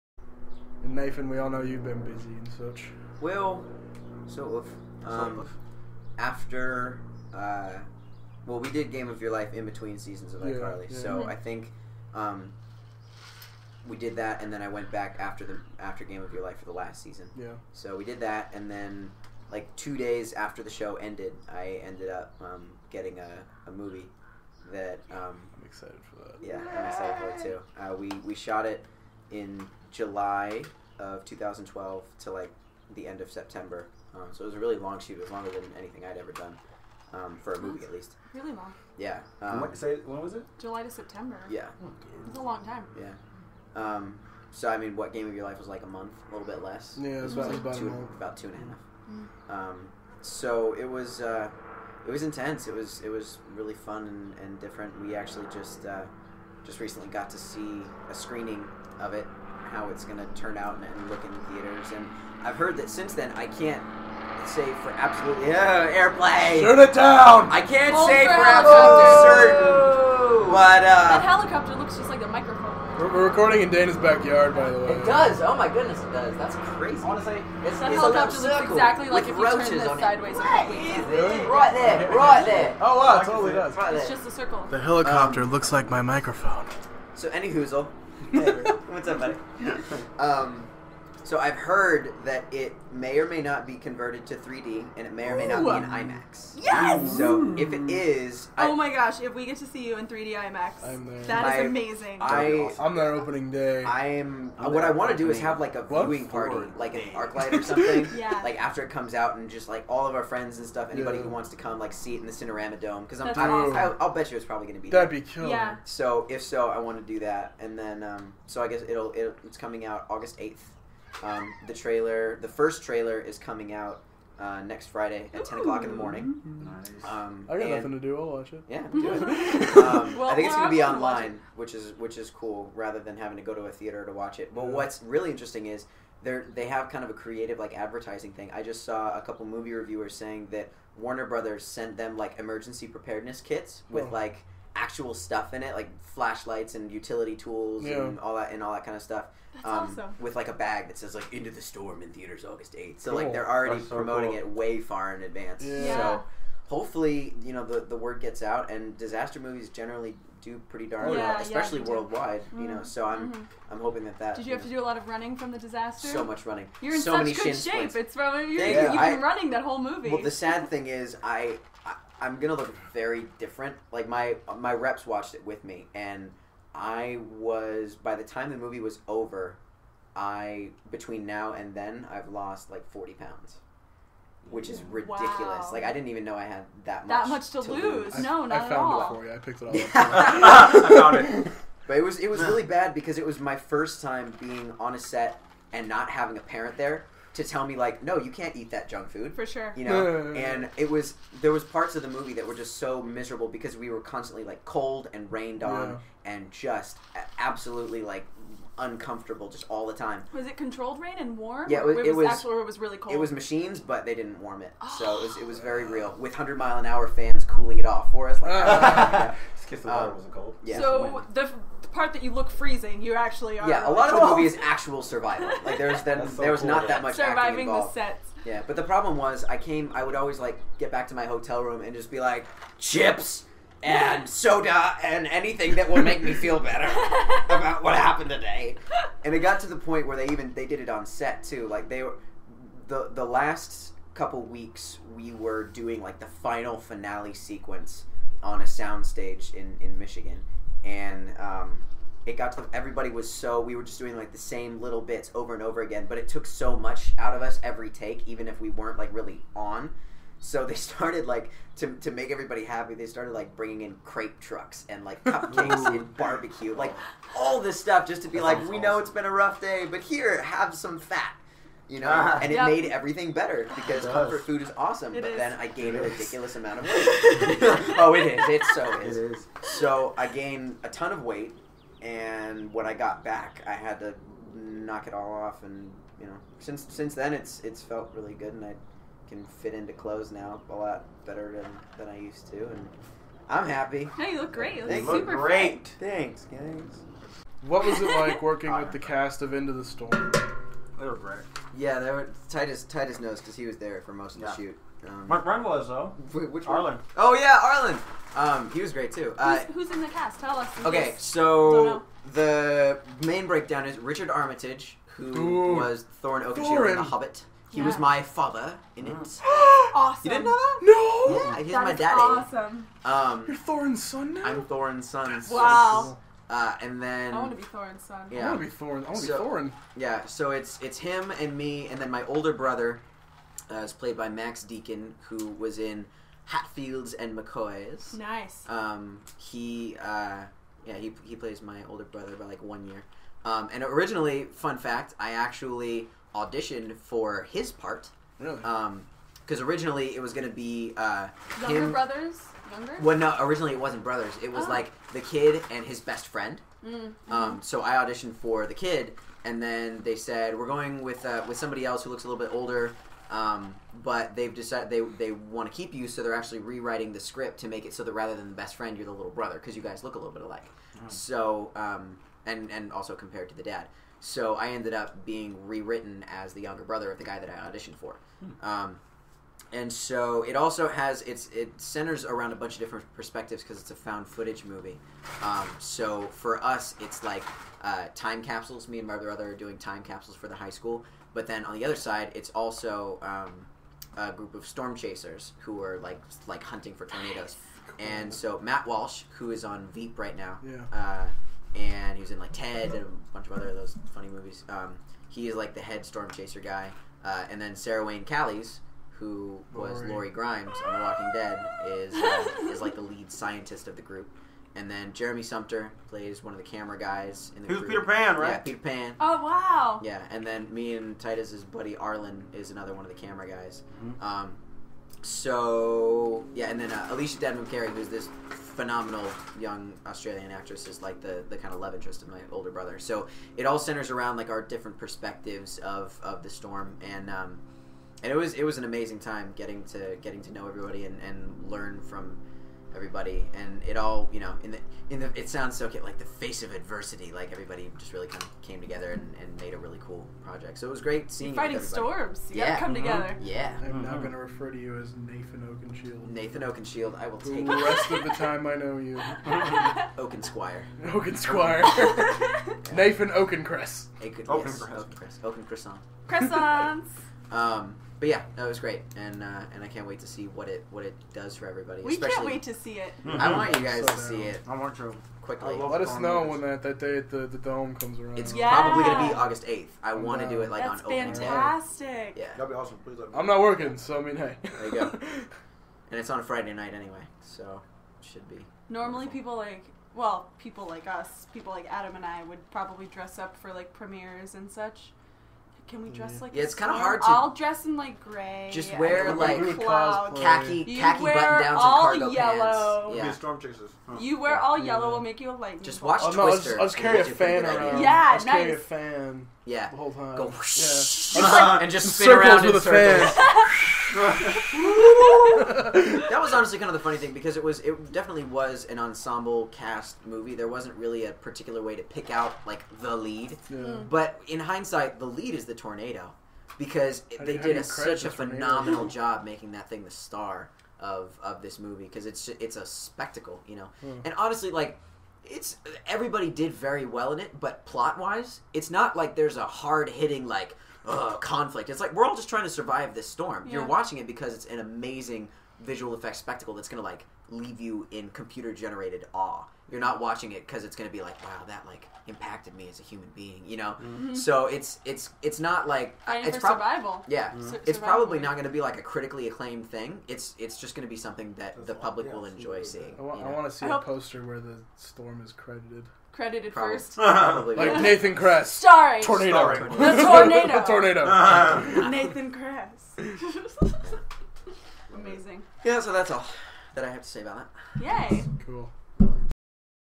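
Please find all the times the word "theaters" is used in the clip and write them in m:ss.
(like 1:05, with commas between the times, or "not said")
1:01, 2:13, 2:32.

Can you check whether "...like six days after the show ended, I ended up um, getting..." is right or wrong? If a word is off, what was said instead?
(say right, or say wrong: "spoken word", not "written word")
wrong: "two", not "six".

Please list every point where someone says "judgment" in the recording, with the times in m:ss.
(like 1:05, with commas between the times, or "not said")
not said.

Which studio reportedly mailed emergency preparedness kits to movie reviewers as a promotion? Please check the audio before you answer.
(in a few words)
Warner Brothers.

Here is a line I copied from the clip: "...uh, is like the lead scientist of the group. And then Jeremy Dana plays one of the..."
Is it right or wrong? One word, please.
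wrong.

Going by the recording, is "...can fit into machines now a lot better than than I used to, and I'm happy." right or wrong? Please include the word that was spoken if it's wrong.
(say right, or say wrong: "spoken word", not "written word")
wrong: "clothes", not "machines".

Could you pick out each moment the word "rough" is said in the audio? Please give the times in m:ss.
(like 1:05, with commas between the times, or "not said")
4:29.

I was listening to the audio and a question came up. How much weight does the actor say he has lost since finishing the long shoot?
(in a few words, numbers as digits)
40 pounds.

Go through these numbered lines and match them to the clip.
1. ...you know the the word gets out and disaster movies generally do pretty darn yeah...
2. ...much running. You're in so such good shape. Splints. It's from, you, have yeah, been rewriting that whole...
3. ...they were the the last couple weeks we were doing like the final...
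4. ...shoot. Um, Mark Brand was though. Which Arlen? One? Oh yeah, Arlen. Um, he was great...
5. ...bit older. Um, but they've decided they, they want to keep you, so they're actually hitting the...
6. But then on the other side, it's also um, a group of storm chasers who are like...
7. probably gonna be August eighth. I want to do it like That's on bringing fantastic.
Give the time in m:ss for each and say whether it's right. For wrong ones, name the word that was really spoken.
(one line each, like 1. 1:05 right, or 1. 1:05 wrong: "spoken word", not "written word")
1. 2:37 right
2. 2:46 wrong: "running", not "rewriting"
3. 4:01 right
4. 5:04 right
5. 6:02 wrong: "rewriting", not "hitting"
6. 6:31 right
7. 7:58 wrong: "opening", not "bringing".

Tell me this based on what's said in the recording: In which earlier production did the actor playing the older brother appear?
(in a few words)
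Hatfields and McCoys.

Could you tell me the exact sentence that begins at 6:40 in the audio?
uh, and he was in like Ted and a bunch of other those funny movies.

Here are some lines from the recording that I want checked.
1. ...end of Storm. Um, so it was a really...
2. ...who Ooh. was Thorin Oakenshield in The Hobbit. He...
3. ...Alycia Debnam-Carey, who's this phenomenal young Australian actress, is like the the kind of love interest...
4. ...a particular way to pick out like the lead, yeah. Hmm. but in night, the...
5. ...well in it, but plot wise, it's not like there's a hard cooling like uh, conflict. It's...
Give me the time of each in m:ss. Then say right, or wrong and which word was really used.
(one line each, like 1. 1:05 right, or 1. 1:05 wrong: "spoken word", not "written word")
1. 0:33 wrong: "September", not "Storm"
2. 5:15 right
3. 7:07 right
4. 8:41 wrong: "hindsight", not "night"
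5. 8:57 wrong: "hitting", not "cooling".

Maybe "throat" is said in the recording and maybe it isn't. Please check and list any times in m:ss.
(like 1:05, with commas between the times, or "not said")
not said.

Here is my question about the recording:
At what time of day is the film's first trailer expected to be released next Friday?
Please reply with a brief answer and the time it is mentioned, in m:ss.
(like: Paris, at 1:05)
10 a.m., at 2:05.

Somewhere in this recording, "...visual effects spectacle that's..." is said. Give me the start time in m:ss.
9:05.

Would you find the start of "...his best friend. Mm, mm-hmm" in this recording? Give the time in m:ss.
5:55.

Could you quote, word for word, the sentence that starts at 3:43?
Yeah, a lot of the movie is actual survival.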